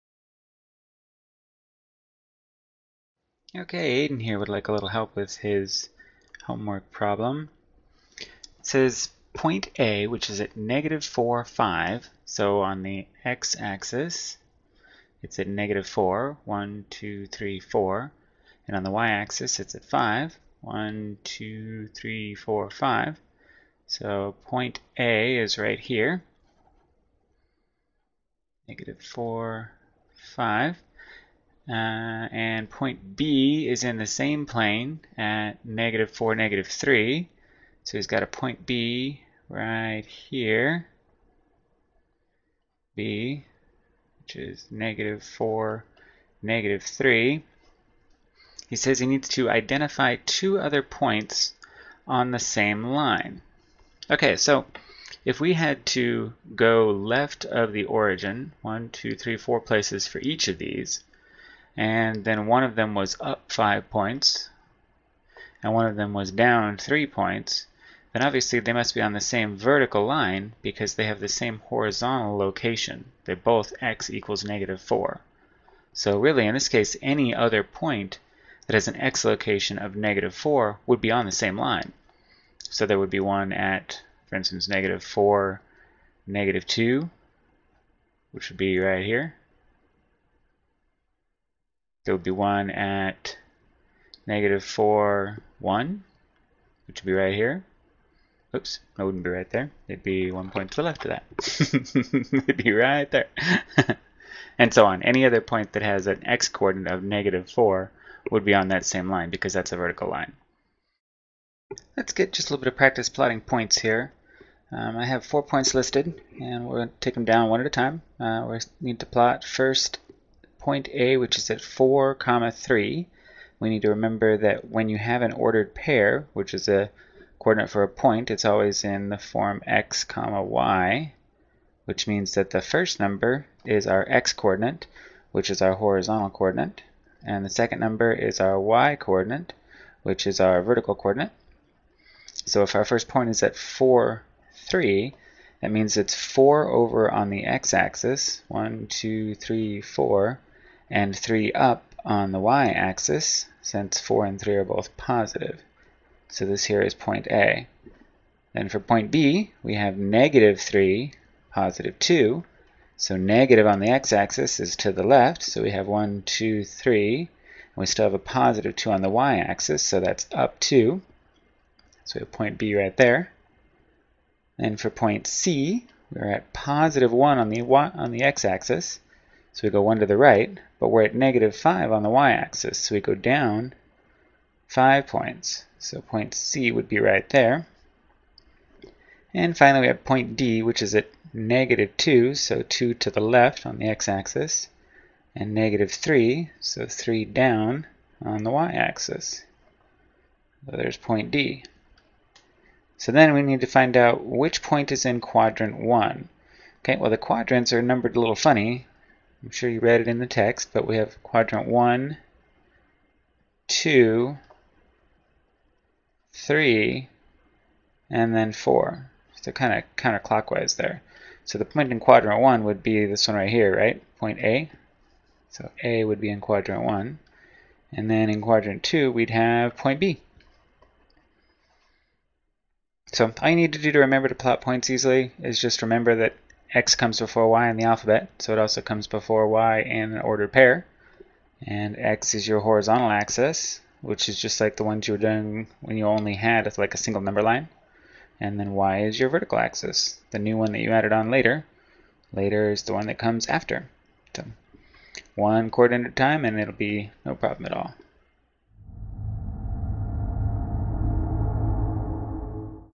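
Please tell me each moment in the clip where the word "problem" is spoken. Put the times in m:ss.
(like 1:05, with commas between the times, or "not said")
0:06, 4:17.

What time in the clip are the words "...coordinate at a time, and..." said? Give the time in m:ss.
4:15.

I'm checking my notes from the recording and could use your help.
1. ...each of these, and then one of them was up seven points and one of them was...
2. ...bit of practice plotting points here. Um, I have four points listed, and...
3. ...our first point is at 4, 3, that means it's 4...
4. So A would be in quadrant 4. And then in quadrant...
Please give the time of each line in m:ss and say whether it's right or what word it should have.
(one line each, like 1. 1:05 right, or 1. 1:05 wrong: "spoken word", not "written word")
1. 1:00 wrong: "five", not "seven"
2. 1:52 right
3. 2:22 right
4. 3:45 wrong: "1", not "4".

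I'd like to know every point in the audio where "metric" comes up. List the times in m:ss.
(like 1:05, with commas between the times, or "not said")
not said.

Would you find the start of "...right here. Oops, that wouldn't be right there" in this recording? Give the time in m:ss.
1:37.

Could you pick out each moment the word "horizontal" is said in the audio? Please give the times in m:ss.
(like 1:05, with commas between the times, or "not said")
1:11, 2:15, 4:02.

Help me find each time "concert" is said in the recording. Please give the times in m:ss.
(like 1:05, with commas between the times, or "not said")
not said.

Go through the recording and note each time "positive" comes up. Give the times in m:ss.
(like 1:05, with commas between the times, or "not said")
2:34, 2:41, 2:48, 2:56.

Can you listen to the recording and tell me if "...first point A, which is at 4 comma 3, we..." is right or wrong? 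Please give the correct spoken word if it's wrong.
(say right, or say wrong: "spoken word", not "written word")
right.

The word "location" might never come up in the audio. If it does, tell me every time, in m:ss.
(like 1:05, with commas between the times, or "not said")
1:12, 1:19.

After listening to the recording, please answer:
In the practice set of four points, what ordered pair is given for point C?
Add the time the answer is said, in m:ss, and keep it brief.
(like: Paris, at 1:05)
1, -5, at 2:56.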